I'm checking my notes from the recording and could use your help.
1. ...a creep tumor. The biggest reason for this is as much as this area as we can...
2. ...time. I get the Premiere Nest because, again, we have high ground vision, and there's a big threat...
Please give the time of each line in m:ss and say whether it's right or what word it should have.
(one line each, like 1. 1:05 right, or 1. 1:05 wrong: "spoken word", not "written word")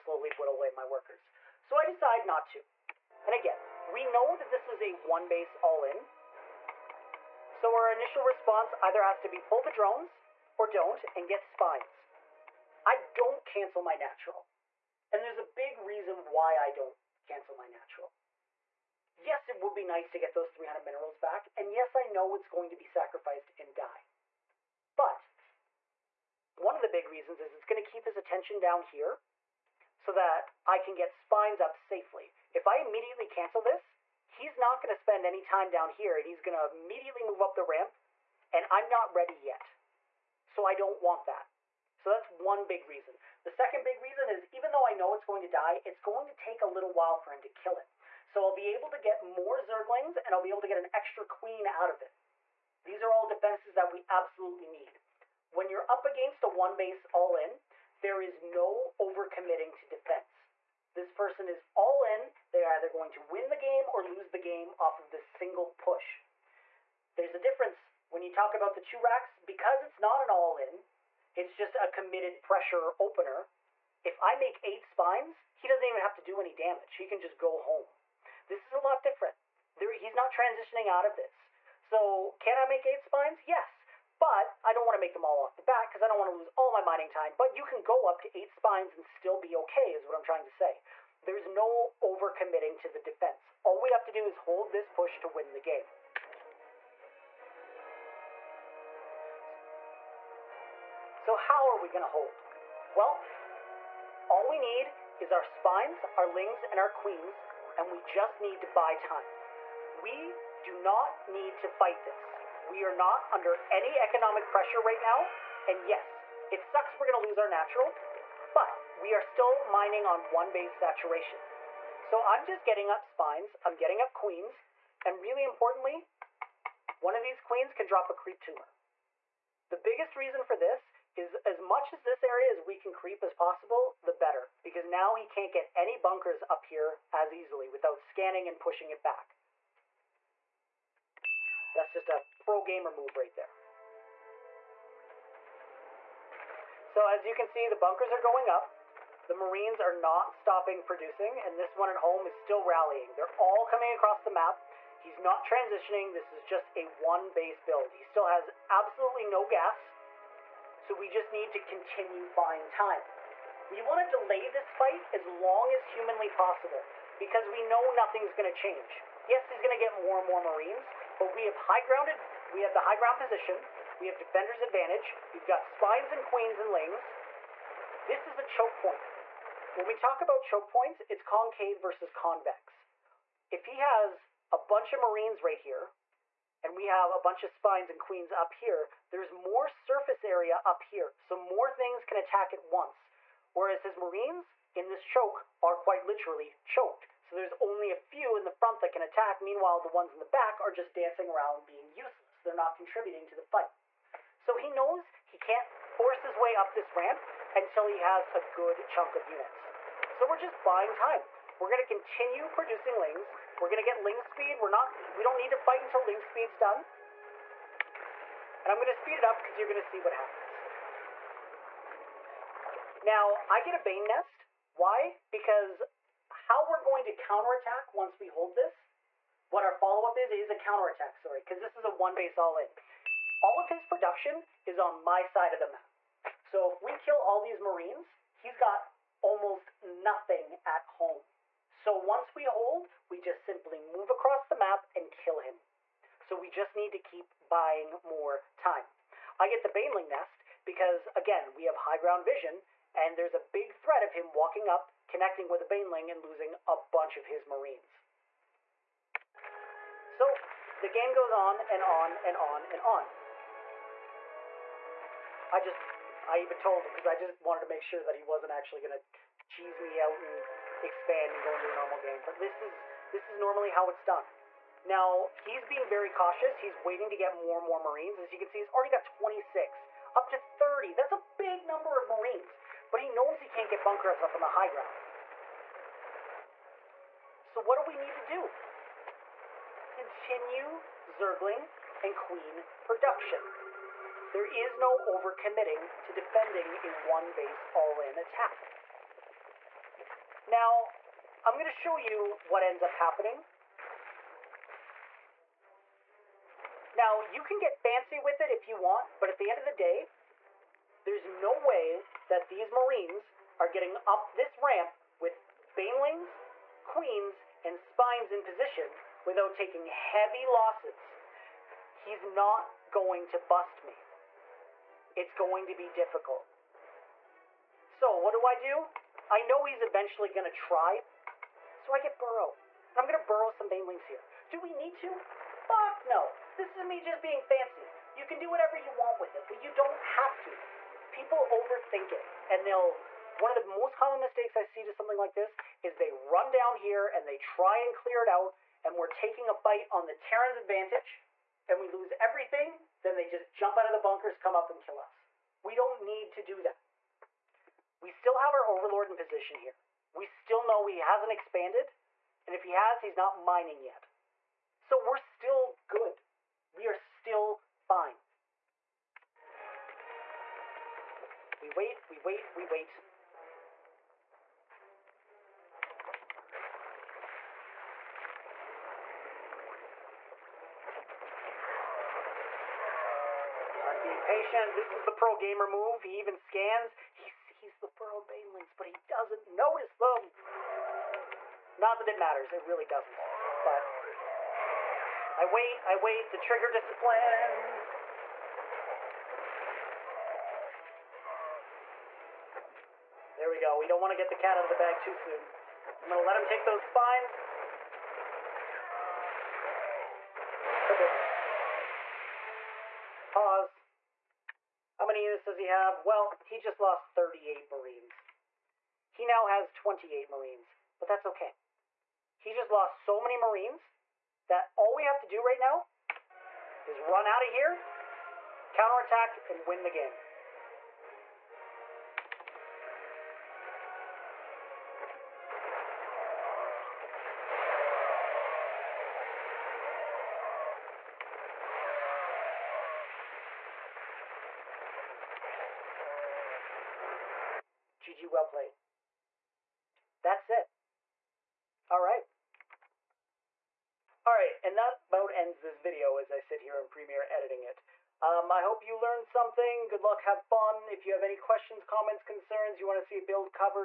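1. 2:08 right
2. 4:08 wrong: "Baneling", not "Premiere".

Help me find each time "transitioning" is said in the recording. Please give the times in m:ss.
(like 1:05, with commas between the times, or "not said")
1:20, 2:35.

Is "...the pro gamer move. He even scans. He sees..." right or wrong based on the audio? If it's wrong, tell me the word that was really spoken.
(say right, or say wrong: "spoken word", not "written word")
right.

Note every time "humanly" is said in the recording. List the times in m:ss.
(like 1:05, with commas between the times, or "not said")
2:45.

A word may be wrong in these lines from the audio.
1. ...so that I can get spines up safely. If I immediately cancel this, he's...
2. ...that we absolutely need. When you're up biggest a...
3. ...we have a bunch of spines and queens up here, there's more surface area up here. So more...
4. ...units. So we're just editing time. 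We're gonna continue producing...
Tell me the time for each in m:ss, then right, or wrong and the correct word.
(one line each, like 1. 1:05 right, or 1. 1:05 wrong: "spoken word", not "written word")
1. 0:29 right
2. 0:53 wrong: "against", not "biggest"
3. 3:06 right
4. 3:29 wrong: "buying", not "editing".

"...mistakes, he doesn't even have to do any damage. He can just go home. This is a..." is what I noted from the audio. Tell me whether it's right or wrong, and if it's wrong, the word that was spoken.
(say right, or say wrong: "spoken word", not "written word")
wrong: "spines", not "mistakes".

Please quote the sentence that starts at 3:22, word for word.
They're not contributing to the fight.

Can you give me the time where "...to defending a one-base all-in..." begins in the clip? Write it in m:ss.
4:56.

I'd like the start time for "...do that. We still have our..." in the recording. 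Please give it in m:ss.
5:56.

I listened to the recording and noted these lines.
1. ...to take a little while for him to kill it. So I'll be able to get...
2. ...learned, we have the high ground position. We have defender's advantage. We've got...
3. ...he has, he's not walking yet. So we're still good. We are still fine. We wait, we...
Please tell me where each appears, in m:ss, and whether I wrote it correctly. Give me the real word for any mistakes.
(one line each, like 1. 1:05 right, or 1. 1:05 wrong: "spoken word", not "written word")
1. 0:46 right
2. 2:51 wrong: "grounded", not "learned"
3. 6:02 wrong: "mining", not "walking".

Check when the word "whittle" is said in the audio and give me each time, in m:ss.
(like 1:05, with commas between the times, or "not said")
0:00.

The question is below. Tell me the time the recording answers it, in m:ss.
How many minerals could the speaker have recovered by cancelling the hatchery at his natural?
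0:20.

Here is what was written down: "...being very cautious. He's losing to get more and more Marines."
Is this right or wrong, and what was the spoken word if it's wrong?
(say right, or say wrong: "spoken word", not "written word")
wrong: "waiting", not "losing".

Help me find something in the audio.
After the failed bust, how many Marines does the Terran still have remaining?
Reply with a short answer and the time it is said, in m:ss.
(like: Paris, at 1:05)
28, at 6:59.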